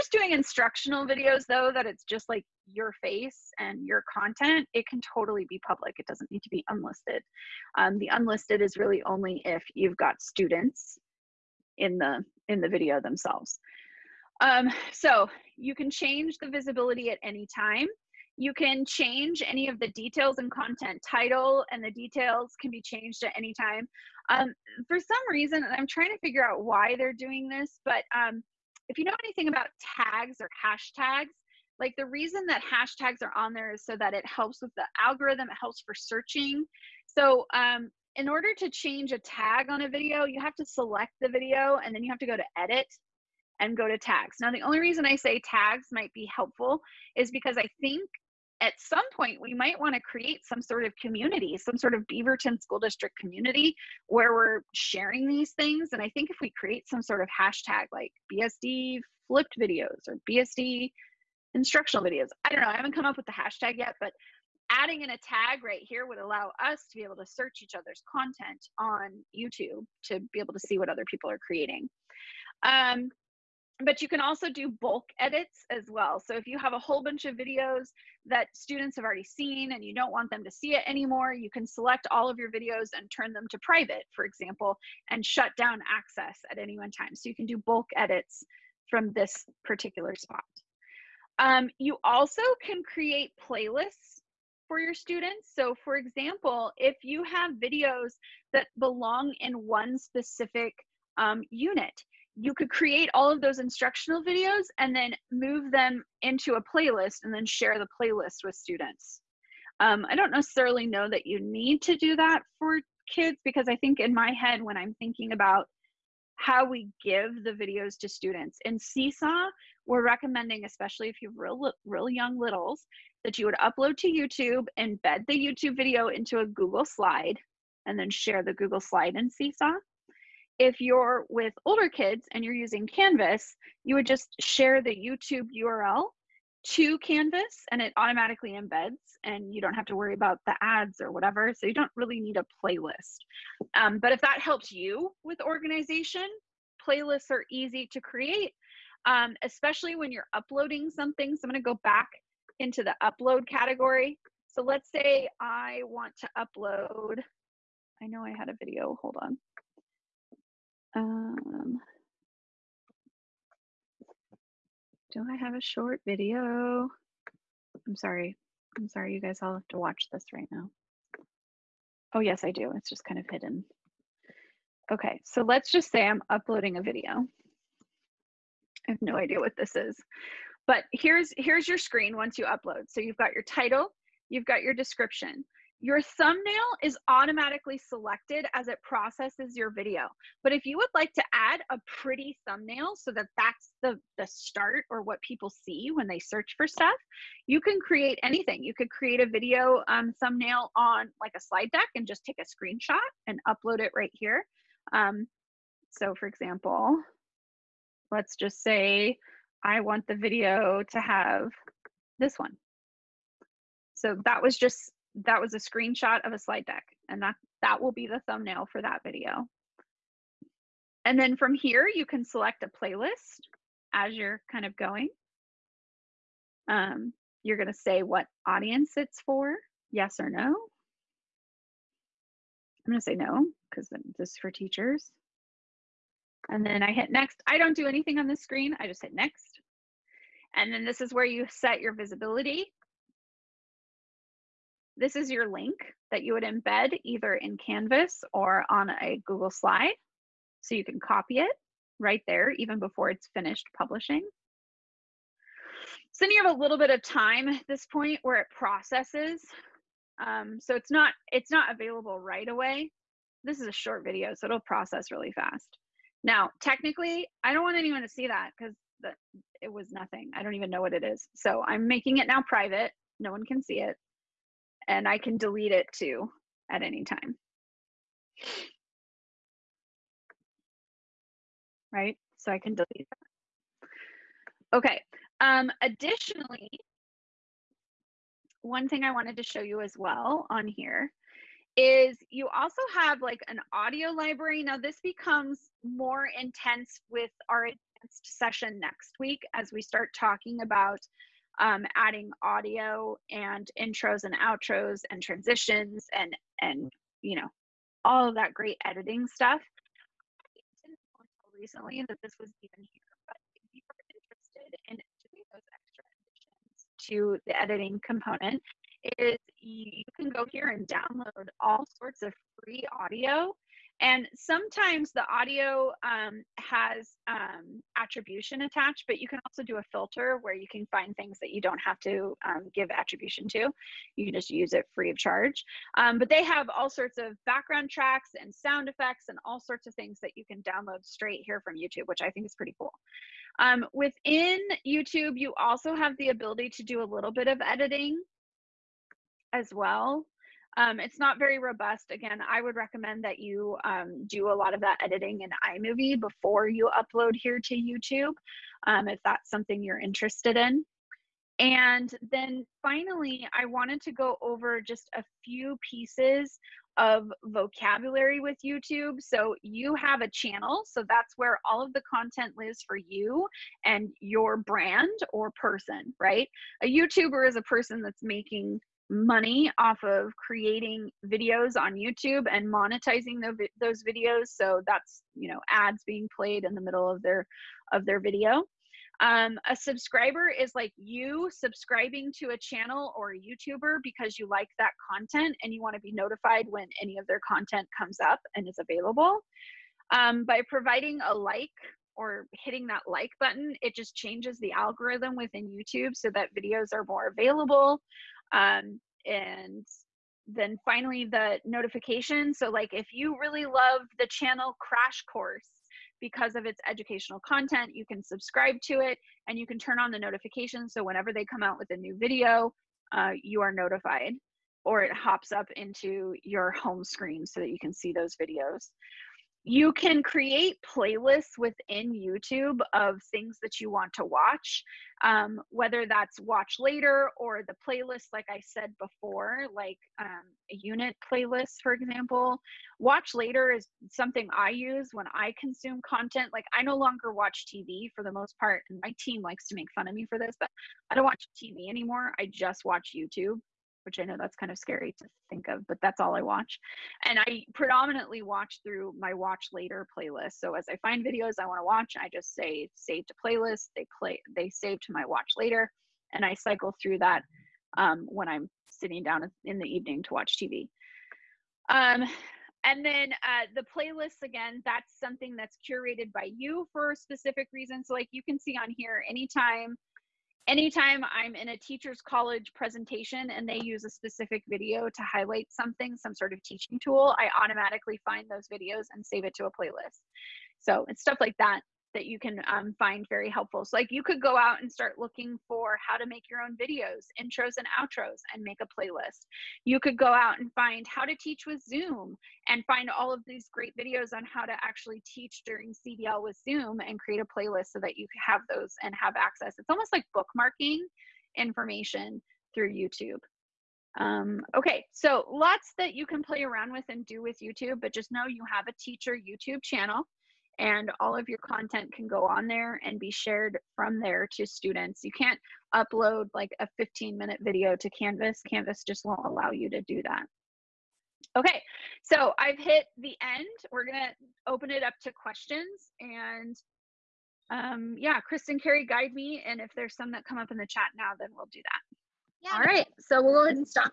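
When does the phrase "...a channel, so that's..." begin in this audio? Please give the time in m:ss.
6:10.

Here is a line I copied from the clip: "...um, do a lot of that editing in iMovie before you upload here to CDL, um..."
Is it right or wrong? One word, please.
wrong.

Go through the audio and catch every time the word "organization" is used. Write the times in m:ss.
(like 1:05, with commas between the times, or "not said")
2:25.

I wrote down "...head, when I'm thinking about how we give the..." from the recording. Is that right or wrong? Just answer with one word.
right.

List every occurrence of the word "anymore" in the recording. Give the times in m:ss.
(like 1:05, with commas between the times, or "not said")
1:20, 7:31.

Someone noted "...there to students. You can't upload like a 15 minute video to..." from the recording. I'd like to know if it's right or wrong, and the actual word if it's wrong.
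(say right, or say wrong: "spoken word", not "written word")
right.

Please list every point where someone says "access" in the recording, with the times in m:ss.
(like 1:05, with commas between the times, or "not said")
1:25, 8:29.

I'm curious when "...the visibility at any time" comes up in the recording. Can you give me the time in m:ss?
0:16.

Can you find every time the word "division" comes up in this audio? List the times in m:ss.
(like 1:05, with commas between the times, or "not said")
not said.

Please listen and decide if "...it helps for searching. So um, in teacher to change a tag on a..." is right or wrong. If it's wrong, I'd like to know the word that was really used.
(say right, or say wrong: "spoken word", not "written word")
wrong: "order", not "teacher".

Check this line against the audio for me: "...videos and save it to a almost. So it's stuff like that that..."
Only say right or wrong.
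wrong.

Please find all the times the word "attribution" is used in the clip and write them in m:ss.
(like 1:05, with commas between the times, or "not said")
5:27, 5:32.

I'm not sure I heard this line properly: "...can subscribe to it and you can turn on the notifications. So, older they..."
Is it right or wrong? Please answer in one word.
wrong.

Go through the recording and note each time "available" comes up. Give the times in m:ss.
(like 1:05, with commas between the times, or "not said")
4:21, 6:38, 6:47.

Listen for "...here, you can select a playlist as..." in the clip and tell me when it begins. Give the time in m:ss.
3:41.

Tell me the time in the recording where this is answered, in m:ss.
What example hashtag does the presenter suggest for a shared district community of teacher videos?
0:58.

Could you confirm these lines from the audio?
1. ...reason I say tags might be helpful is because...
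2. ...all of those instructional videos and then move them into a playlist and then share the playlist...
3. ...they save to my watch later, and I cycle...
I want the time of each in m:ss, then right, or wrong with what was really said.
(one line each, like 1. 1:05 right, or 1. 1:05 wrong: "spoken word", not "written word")
1. 0:44 right
2. 1:43 right
3. 7:44 right.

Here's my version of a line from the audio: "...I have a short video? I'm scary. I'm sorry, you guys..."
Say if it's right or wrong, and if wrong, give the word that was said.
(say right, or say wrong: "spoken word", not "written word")
wrong: "sorry", not "scary".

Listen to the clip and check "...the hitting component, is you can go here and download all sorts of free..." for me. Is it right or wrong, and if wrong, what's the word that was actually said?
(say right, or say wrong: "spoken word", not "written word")
wrong: "editing", not "hitting".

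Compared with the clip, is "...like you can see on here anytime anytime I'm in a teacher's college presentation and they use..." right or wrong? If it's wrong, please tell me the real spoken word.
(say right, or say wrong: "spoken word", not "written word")
right.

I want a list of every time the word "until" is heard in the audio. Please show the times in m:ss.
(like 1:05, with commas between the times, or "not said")
5:11.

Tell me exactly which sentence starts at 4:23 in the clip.
This is a short video, so it'll process really fast.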